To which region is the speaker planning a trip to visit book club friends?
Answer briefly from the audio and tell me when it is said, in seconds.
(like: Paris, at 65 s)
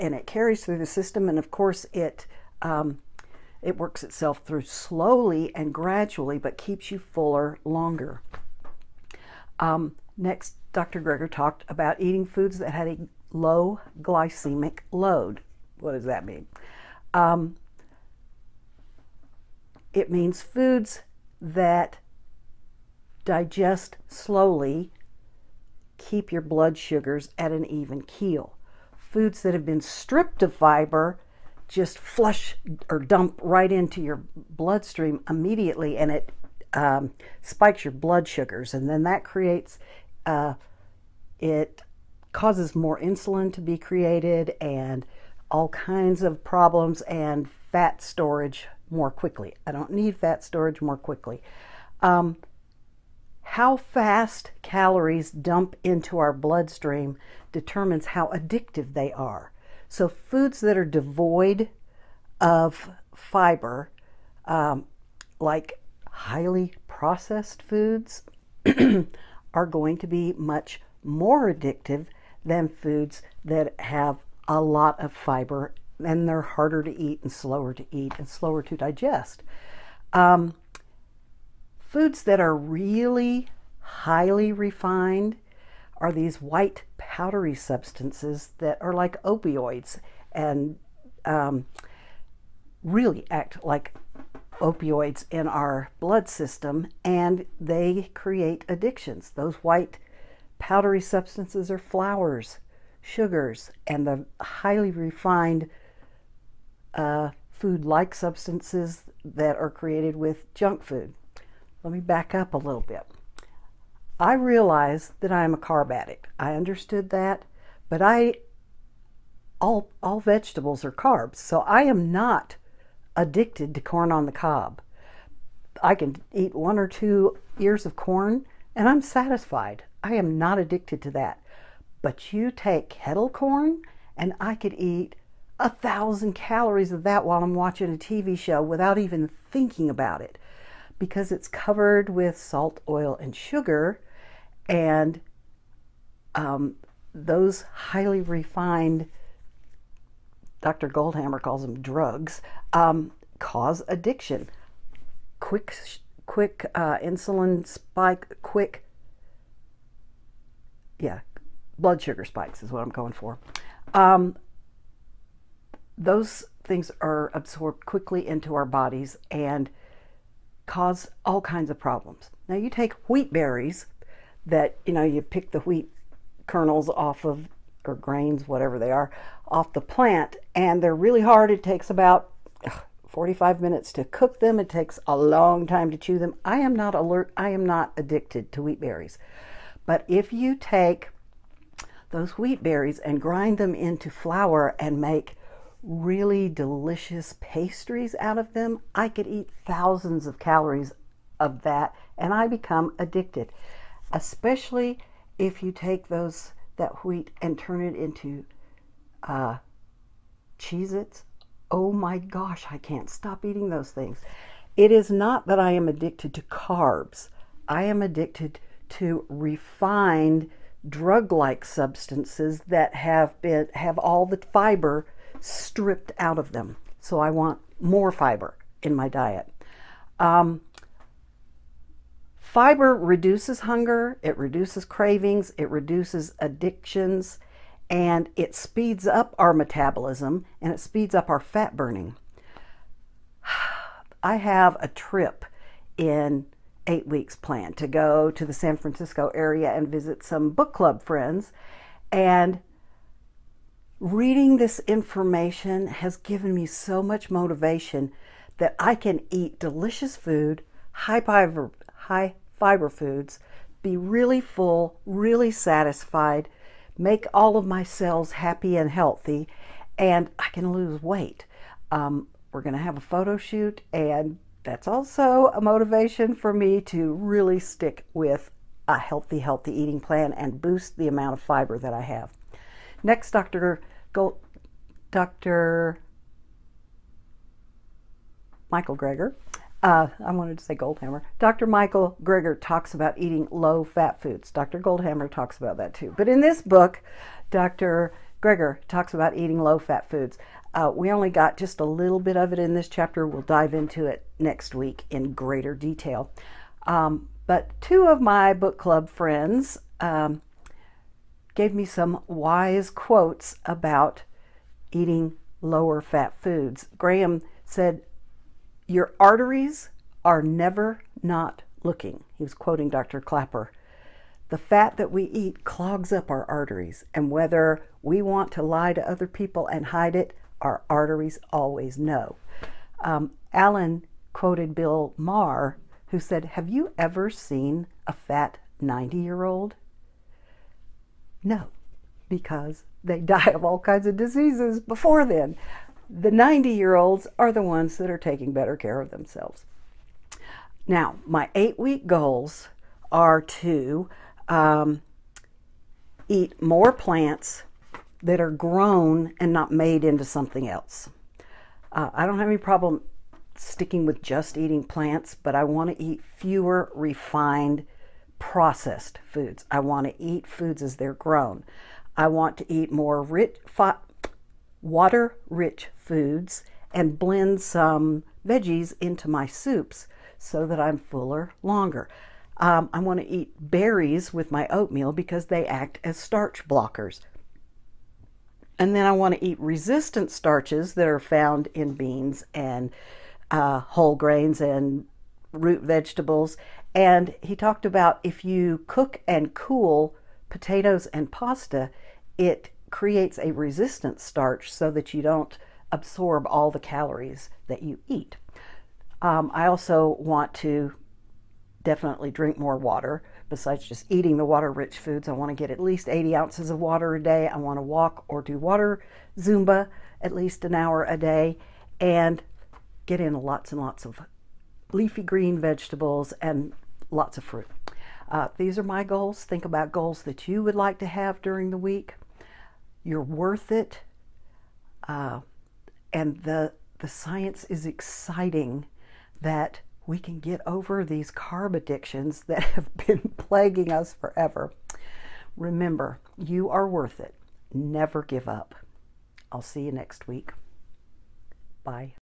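San Francisco area, at 248 s.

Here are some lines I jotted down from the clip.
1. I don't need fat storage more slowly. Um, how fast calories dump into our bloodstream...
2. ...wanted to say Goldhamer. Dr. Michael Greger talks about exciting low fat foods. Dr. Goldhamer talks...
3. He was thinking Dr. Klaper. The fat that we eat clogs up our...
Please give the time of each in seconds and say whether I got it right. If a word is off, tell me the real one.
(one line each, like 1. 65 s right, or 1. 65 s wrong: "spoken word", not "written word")
1. 49 s wrong: "quickly", not "slowly"
2. 290 s wrong: "eating", not "exciting"
3. 322 s wrong: "quoting", not "thinking".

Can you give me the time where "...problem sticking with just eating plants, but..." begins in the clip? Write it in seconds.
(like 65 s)
362 s.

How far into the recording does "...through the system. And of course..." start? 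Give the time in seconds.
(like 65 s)
0 s.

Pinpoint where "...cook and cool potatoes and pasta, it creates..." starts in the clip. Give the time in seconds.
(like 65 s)
398 s.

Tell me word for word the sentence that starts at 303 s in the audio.
We'll dive into it next week in greater detail.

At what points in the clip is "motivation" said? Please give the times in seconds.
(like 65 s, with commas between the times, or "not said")
257 s, 275 s.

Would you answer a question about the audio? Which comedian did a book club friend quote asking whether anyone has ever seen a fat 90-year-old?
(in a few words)
Bill Maher.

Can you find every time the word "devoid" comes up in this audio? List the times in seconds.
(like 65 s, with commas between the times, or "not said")
60 s.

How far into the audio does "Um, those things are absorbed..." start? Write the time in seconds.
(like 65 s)
163 s.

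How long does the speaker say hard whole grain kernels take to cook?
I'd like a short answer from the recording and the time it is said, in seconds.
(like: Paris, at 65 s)
45 minutes, at 183 s.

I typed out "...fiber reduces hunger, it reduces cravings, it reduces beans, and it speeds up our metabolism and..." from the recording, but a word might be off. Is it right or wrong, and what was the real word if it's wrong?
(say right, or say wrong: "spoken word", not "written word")
wrong: "addictions", not "beans".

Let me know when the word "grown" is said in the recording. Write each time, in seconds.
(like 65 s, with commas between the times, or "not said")
358 s, 371 s.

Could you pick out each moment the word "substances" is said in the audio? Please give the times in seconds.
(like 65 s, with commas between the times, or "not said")
87 s, 101 s, 108 s, 221 s.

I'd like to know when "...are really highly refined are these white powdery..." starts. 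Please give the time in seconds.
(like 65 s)
82 s.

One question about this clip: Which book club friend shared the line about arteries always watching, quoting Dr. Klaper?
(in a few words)
Graham.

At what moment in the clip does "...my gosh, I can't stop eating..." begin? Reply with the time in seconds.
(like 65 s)
211 s.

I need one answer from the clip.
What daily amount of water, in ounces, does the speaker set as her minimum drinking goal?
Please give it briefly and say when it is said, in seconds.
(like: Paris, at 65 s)
80 ounces, at 416 s.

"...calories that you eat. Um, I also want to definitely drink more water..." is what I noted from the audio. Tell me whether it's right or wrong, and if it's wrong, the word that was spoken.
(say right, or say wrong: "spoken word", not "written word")
right.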